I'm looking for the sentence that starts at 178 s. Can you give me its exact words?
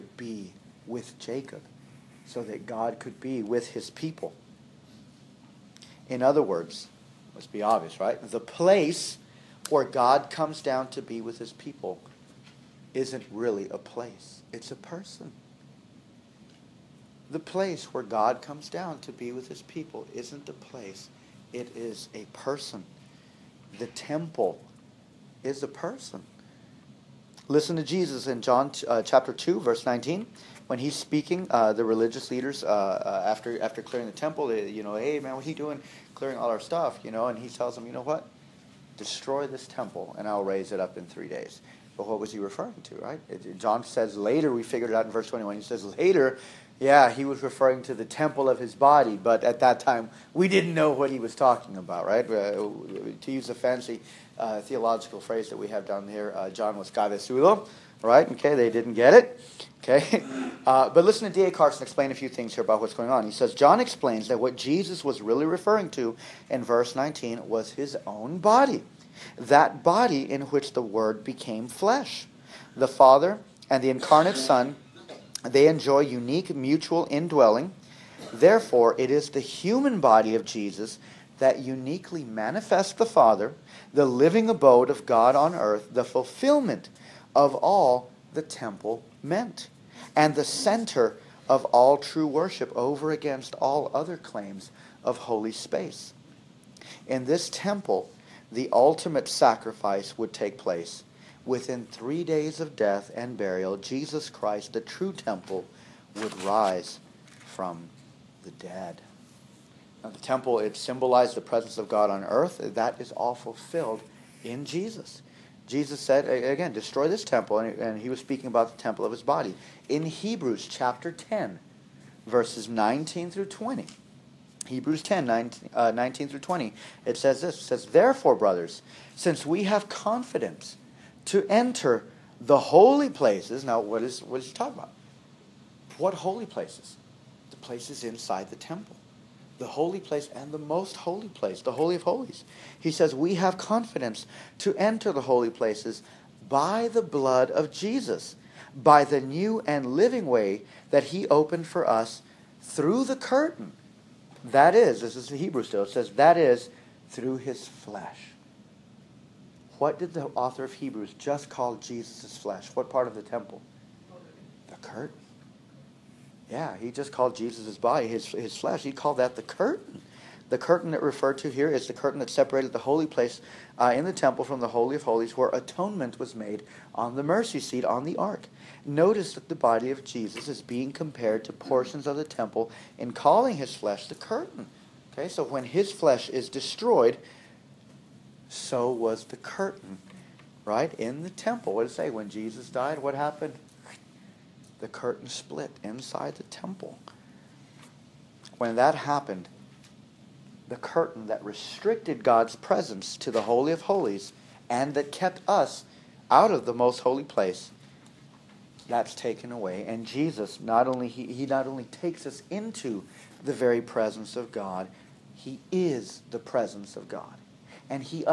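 Notice that the body of Jesus is being compared to portions of the temple in calling his flesh the curtain.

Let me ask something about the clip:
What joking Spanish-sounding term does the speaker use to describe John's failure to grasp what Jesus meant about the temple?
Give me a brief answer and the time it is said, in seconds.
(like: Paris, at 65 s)
Cabezudo, at 56 s.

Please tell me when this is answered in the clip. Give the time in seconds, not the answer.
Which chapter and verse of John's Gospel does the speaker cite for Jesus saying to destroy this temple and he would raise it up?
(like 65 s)
29 s.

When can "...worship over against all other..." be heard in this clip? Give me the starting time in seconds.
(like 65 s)
92 s.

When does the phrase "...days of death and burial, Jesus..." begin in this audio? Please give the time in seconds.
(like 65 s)
102 s.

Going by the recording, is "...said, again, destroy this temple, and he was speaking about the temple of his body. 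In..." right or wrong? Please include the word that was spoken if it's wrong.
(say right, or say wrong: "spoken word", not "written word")
right.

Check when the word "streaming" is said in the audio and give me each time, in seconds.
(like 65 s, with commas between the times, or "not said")
not said.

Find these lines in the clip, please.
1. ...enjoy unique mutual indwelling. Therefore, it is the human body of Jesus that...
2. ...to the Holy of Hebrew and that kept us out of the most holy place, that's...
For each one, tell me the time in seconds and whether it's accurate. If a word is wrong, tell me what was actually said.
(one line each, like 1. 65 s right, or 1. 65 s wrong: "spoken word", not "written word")
1. 75 s right
2. 203 s wrong: "Holies", not "Hebrew".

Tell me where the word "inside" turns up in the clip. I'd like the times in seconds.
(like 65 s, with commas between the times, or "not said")
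138 s, 195 s.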